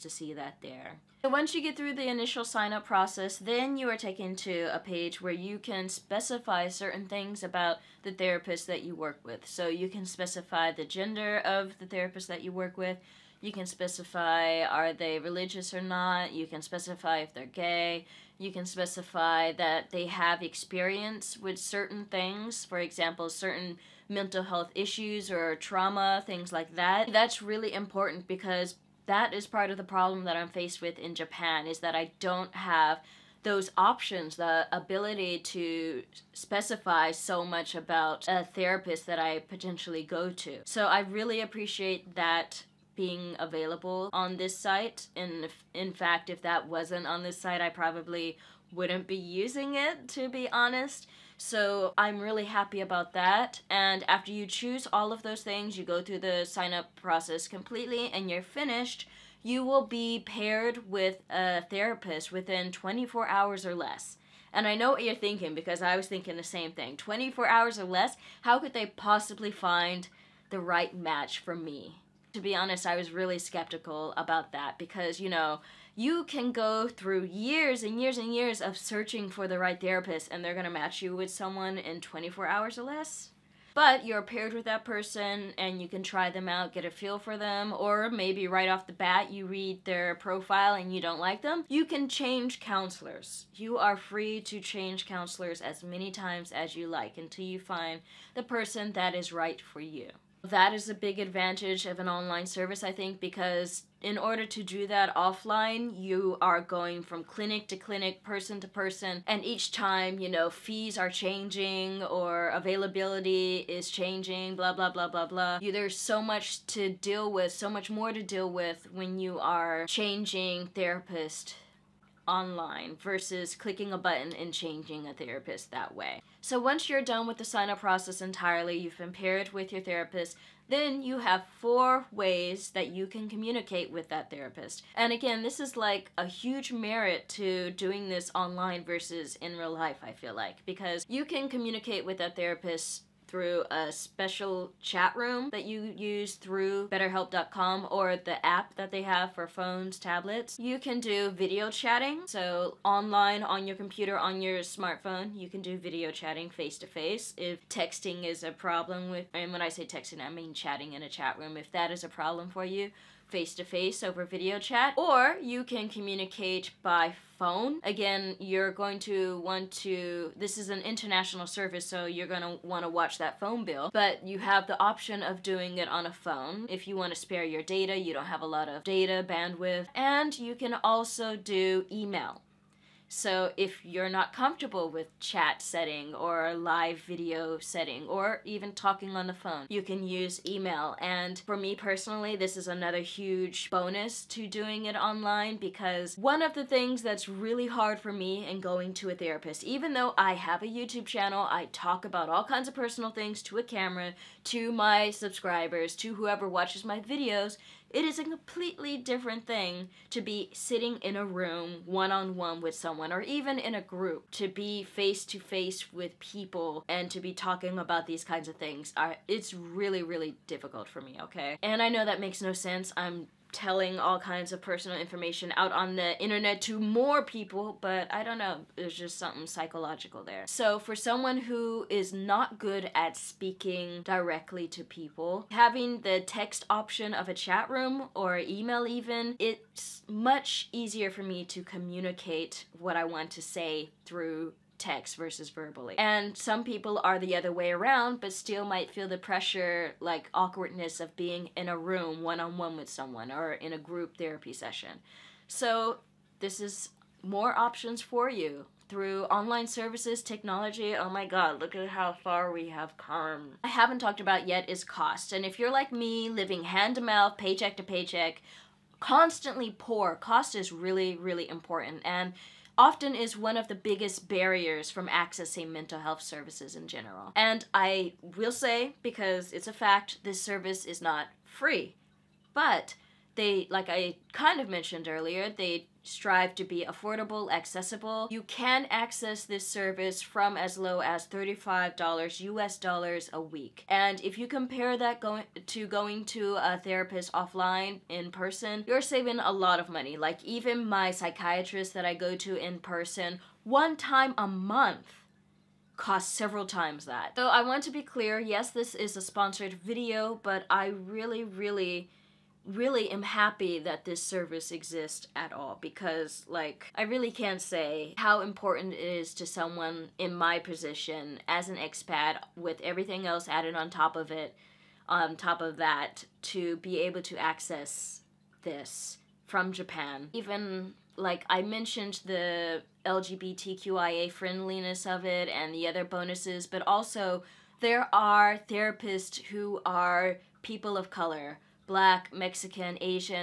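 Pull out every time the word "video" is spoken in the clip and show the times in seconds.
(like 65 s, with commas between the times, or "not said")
151 s, 155 s, 164 s, 186 s, 206 s, 309 s.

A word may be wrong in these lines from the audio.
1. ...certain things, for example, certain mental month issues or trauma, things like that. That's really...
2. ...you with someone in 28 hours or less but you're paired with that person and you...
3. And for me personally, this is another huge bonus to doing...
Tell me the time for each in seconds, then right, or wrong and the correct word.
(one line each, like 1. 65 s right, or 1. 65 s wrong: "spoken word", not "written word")
1. 21 s wrong: "health", not "month"
2. 81 s wrong: "24", not "28"
3. 190 s right.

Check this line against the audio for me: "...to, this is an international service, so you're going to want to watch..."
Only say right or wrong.
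right.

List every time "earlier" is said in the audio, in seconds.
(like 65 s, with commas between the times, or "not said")
285 s.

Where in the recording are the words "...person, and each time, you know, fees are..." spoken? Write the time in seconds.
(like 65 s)
108 s.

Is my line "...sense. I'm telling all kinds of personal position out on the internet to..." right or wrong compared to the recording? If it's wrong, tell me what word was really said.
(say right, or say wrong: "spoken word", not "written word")
wrong: "information", not "position".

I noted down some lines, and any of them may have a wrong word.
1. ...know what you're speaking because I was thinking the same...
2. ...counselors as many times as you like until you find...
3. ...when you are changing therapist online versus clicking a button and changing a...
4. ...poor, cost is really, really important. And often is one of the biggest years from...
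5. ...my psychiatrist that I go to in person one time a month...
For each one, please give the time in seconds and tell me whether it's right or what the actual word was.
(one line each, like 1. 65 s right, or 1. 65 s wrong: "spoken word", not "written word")
1. 64 s wrong: "thinking", not "speaking"
2. 95 s right
3. 118 s right
4. 269 s wrong: "barriers", not "years"
5. 300 s right.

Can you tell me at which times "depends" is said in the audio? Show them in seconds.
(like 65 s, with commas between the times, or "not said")
not said.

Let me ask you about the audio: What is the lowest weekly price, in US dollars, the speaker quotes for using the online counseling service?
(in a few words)
$35.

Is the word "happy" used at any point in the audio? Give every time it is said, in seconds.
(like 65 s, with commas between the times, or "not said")
52 s, 313 s.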